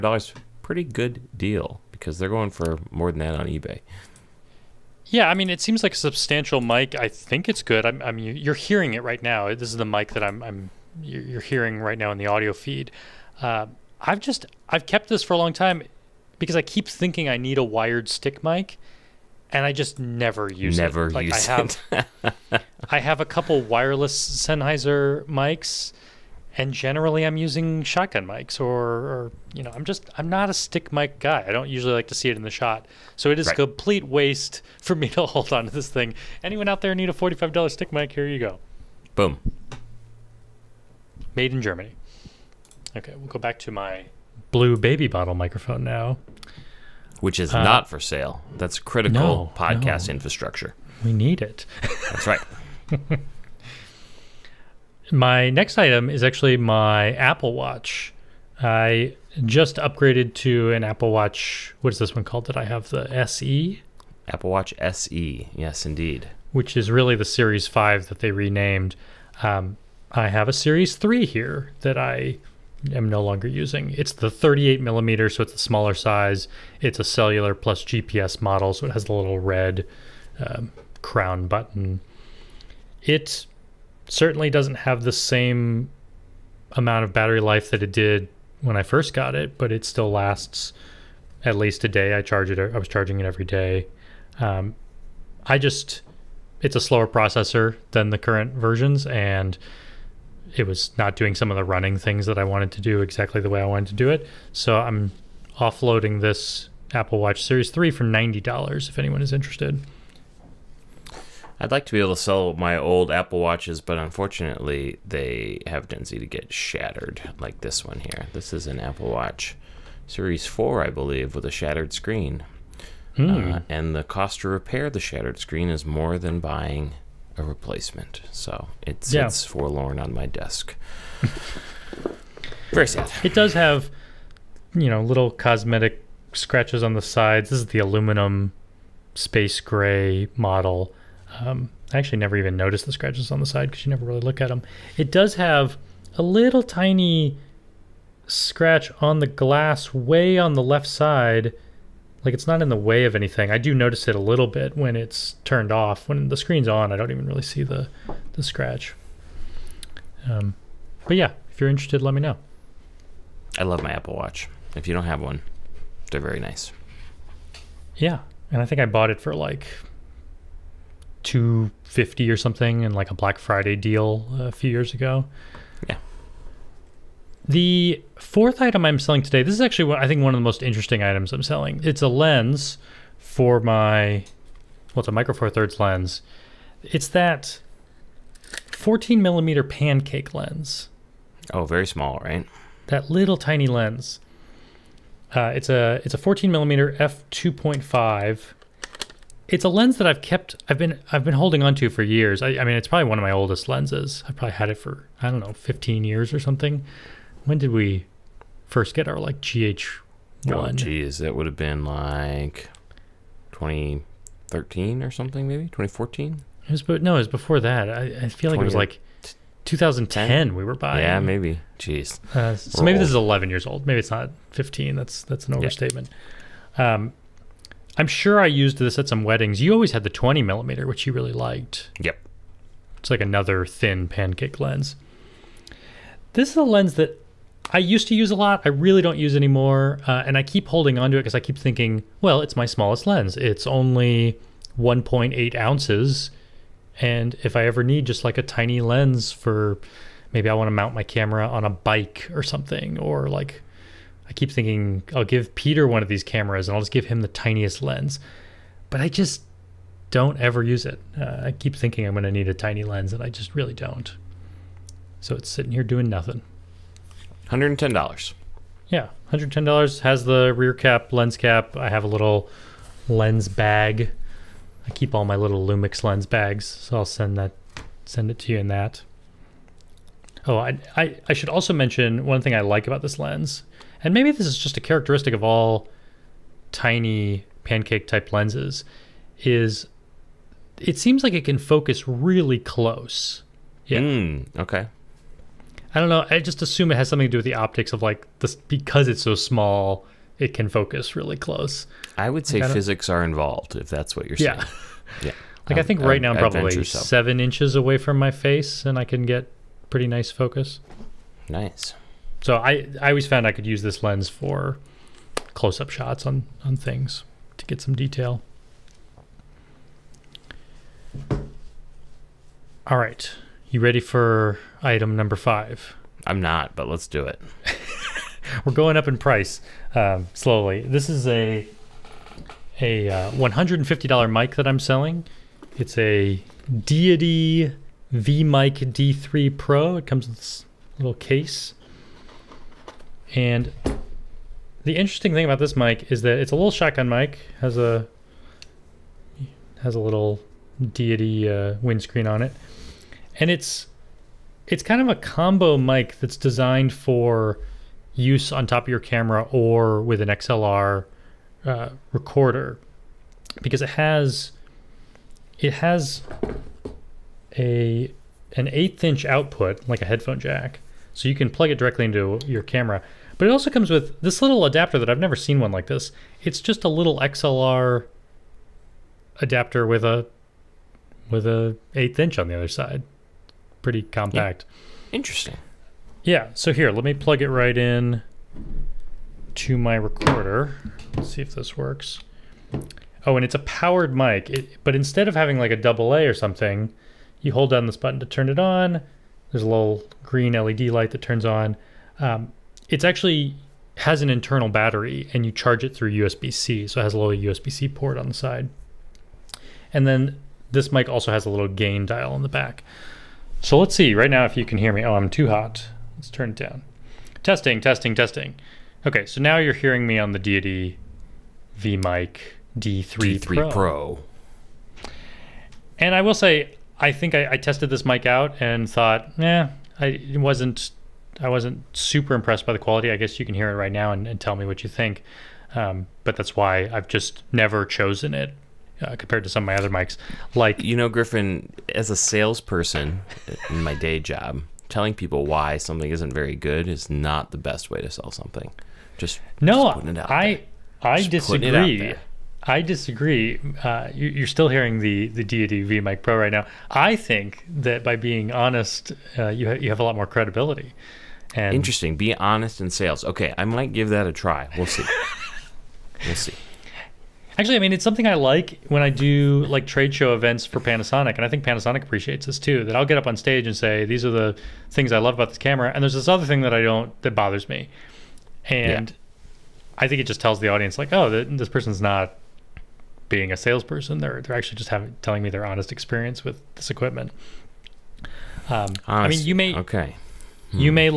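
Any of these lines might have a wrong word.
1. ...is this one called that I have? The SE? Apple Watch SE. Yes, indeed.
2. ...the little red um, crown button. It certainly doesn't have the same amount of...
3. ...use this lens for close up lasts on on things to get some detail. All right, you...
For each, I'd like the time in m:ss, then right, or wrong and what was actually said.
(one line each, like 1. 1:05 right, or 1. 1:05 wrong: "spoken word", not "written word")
1. 1:01 right
2. 1:19 right
3. 5:13 wrong: "shots", not "lasts".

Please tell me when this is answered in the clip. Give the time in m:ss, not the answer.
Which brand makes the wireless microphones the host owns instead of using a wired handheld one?
0:24.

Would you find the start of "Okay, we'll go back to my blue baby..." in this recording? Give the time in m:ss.
0:42.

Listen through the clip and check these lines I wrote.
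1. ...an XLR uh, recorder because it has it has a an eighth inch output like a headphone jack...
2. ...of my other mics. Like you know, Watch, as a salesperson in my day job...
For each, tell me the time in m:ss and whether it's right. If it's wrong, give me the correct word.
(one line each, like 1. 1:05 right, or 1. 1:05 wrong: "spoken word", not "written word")
1. 6:00 right
2. 7:19 wrong: "Griffin", not "Watch".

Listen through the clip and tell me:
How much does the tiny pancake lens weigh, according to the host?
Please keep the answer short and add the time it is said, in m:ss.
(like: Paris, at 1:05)
1.8 ounces, at 4:04.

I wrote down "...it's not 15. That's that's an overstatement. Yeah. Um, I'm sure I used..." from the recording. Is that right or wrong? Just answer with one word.
right.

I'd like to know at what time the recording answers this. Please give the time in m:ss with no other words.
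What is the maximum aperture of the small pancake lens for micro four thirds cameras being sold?
3:16.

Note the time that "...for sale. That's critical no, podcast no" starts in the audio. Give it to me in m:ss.
0:47.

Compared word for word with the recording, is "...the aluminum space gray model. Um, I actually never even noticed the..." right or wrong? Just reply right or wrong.
right.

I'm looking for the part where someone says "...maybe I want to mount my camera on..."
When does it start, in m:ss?
4:10.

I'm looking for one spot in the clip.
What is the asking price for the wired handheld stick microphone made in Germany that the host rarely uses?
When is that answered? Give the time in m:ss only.
0:37.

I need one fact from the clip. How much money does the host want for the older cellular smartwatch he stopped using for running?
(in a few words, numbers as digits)
$90.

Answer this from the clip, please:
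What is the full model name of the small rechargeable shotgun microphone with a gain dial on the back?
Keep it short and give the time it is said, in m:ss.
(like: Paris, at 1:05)
Deity Mic D3 Pro, at 5:36.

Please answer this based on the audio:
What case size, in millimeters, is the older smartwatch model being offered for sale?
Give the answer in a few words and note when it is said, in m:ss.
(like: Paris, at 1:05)
38 millimeter, at 1:14.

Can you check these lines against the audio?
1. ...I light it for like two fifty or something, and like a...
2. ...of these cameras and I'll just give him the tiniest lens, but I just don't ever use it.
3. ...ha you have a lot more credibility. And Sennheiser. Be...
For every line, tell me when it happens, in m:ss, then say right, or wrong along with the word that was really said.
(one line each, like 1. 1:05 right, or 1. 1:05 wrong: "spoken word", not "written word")
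1. 2:48 wrong: "bought", not "light"
2. 4:16 right
3. 7:39 wrong: "Interesting", not "Sennheiser".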